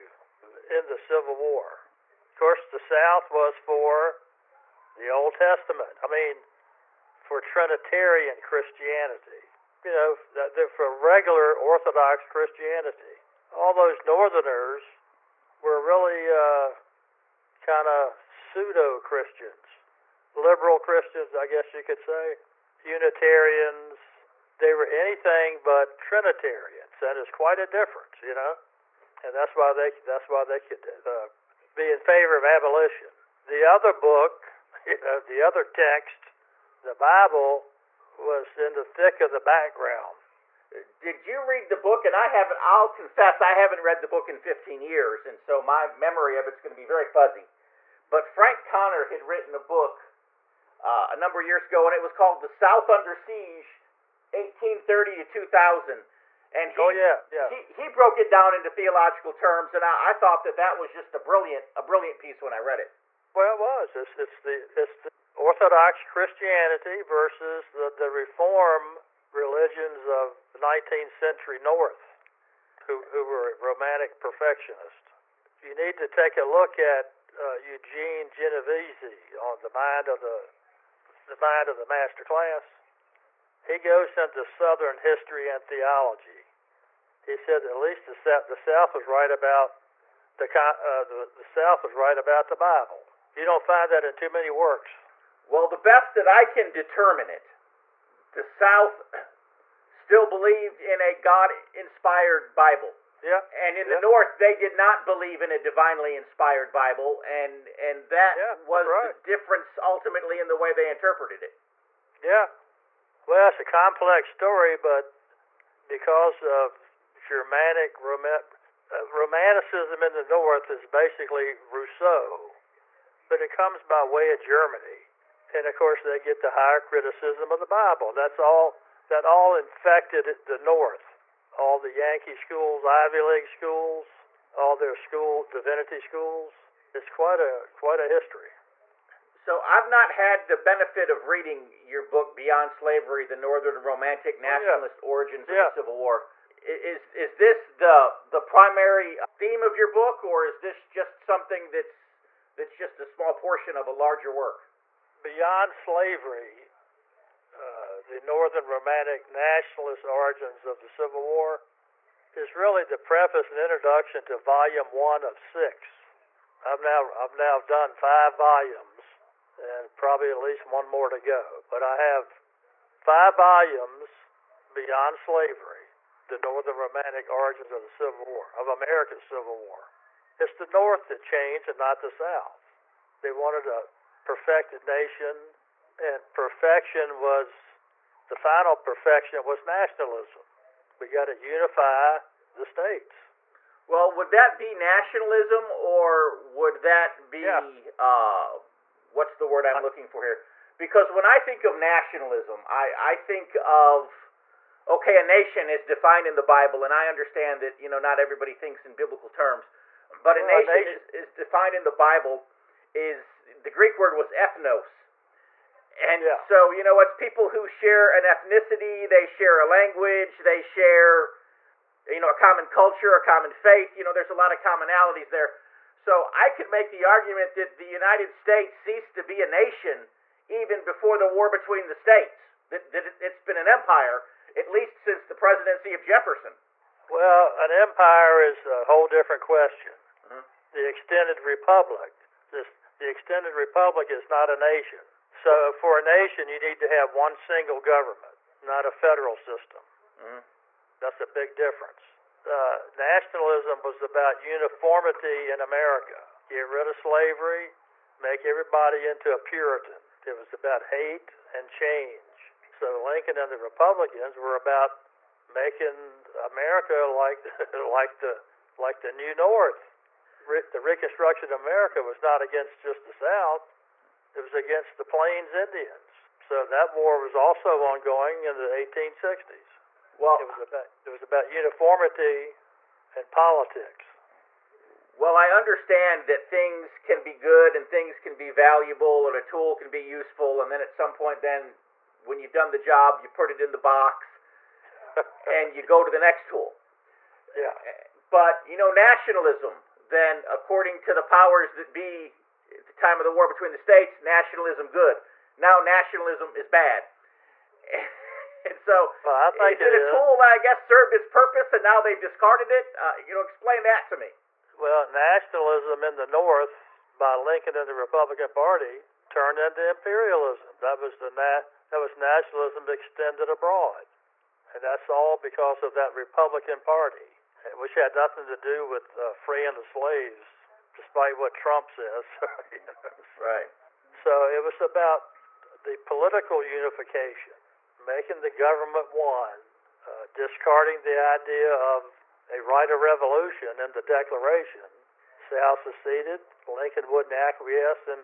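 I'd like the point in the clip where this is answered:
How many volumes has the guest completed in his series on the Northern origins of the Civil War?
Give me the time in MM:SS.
02:48.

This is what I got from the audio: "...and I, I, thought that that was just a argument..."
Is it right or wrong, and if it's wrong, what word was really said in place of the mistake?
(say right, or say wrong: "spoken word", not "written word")
wrong: "brilliant", not "argument".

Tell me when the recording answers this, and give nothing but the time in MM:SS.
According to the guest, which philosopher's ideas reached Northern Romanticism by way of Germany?
02:01.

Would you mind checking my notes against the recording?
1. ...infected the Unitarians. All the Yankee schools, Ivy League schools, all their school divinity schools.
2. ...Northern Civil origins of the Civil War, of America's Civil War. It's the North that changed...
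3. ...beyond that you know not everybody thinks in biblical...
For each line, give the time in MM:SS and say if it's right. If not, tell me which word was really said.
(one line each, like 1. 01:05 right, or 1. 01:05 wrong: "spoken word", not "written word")
1. 02:09 wrong: "North", not "Unitarians"
2. 02:56 wrong: "Romantic", not "Civil"
3. 03:27 wrong: "understand", not "beyond".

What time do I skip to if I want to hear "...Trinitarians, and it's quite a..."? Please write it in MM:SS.
00:25.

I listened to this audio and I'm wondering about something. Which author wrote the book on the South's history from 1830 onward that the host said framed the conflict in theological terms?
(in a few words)
Frank Conner.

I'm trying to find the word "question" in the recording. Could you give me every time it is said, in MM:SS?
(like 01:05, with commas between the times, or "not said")
03:59.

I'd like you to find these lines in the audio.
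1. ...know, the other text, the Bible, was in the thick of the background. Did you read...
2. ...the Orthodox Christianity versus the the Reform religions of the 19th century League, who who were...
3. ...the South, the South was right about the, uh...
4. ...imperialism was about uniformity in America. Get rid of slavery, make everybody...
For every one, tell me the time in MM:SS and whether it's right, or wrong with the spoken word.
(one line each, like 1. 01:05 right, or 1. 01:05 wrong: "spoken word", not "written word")
1. 00:35 right
2. 01:05 wrong: "North", not "League"
3. 01:28 right
4. 04:12 wrong: "nationalism", not "imperialism".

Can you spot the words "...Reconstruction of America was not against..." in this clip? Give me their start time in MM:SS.
04:30.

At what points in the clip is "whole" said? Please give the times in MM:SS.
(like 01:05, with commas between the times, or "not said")
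03:58.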